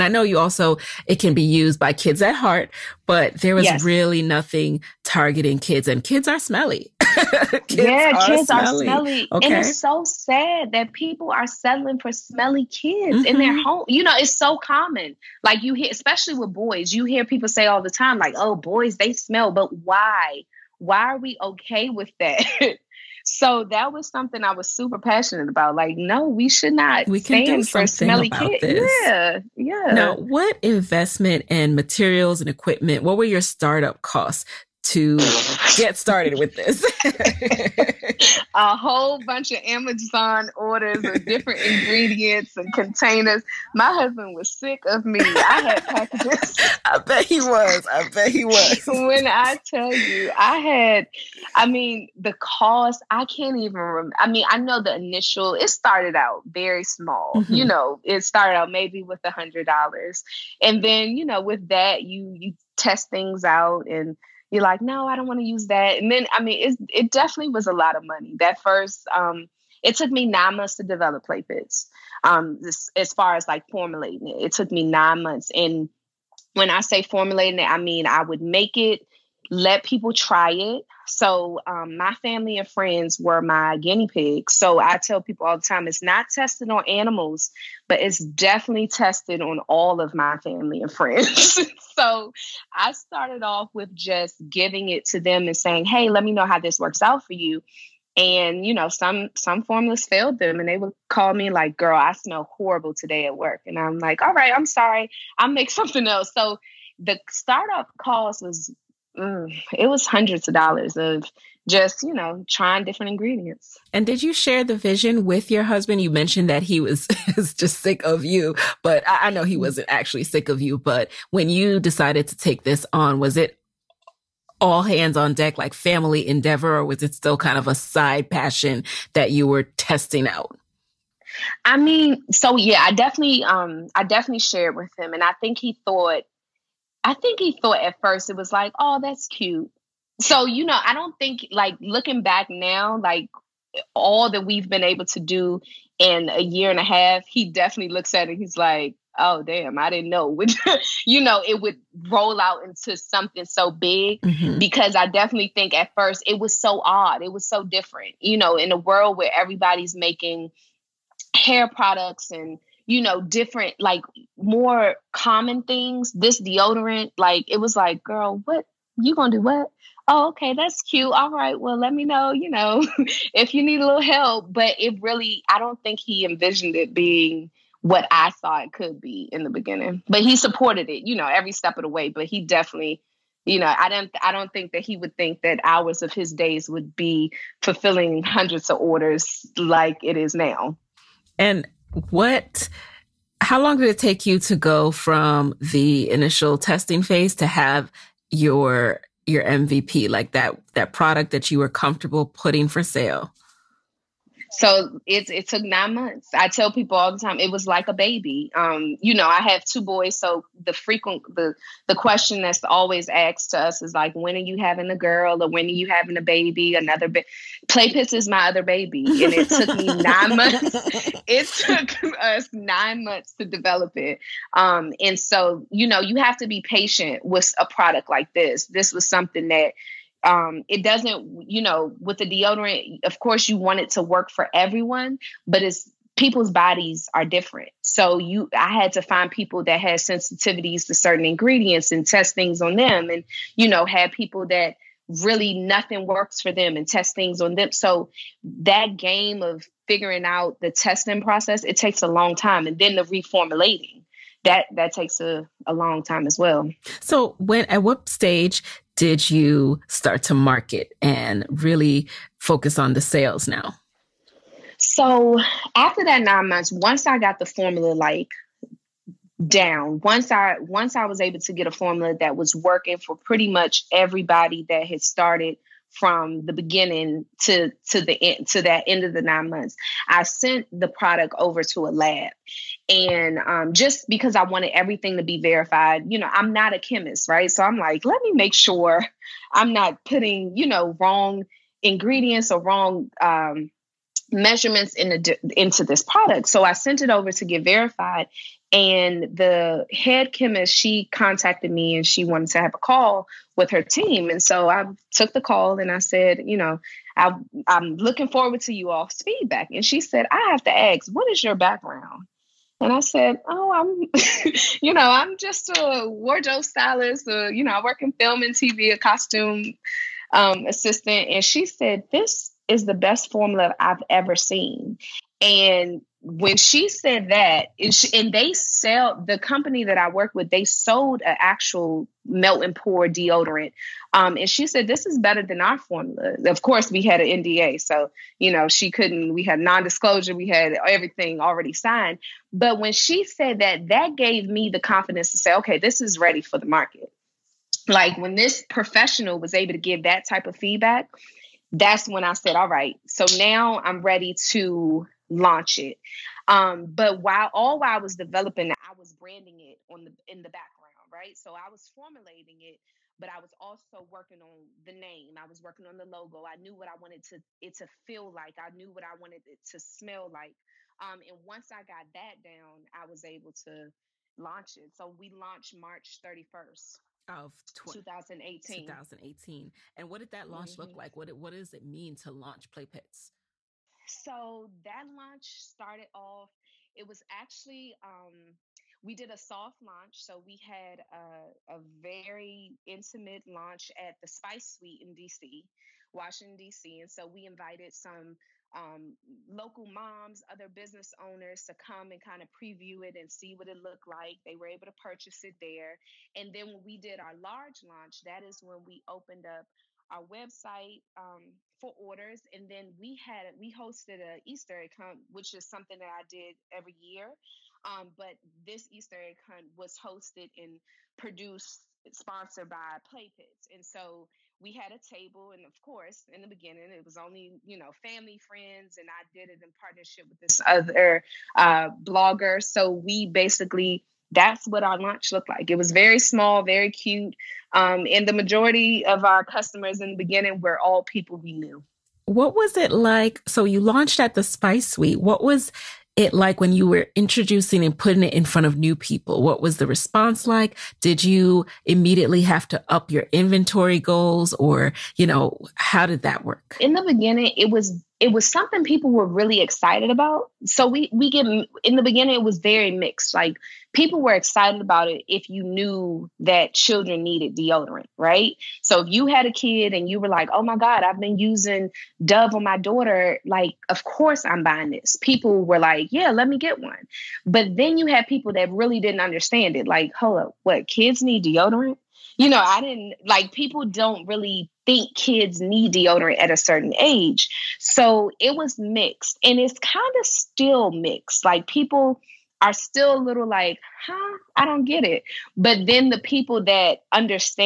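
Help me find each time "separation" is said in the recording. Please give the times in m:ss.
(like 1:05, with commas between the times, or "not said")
not said.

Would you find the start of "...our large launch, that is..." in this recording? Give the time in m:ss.
6:47.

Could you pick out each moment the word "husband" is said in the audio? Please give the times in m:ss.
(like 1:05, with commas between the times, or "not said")
0:43, 1:55.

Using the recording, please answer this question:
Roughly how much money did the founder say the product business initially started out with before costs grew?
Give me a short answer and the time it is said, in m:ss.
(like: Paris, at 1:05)
$100, at 0:59.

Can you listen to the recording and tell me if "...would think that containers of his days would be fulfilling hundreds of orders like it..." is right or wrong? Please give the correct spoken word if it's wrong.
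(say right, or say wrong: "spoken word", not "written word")
wrong: "hours", not "containers".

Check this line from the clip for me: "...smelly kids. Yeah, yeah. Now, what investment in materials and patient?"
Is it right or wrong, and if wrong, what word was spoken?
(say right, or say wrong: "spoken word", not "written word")
wrong: "equipment", not "patient".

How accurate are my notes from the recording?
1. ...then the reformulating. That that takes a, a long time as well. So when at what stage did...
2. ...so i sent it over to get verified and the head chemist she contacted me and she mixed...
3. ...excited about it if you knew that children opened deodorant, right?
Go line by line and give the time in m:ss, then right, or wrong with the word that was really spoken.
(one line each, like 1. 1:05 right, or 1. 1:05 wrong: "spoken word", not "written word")
1. 4:12 right
2. 4:56 wrong: "wanted", not "mixed"
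3. 7:44 wrong: "needed", not "opened".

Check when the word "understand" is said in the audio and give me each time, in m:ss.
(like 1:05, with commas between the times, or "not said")
7:59, 8:17.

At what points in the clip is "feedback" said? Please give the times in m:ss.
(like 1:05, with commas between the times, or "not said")
5:09, 5:50.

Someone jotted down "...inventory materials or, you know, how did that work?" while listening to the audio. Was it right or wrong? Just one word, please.
wrong.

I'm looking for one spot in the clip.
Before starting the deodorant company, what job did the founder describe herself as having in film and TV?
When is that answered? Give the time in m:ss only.
5:16.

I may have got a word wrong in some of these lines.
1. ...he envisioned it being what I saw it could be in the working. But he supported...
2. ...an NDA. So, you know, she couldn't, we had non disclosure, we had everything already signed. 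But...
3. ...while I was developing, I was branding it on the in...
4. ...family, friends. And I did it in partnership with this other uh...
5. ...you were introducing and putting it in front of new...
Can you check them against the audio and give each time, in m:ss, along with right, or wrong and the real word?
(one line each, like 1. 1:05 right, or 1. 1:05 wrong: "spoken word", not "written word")
1. 2:55 wrong: "beginning", not "working"
2. 5:37 right
3. 5:57 right
4. 7:07 right
5. 7:26 right.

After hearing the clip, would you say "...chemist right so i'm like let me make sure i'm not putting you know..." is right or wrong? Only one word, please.
right.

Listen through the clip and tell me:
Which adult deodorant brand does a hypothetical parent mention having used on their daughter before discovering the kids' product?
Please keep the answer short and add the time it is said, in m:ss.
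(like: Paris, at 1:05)
Dove, at 7:52.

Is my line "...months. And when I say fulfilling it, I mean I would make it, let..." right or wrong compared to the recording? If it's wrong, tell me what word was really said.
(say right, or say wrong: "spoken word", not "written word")
wrong: "formulating", not "fulfilling".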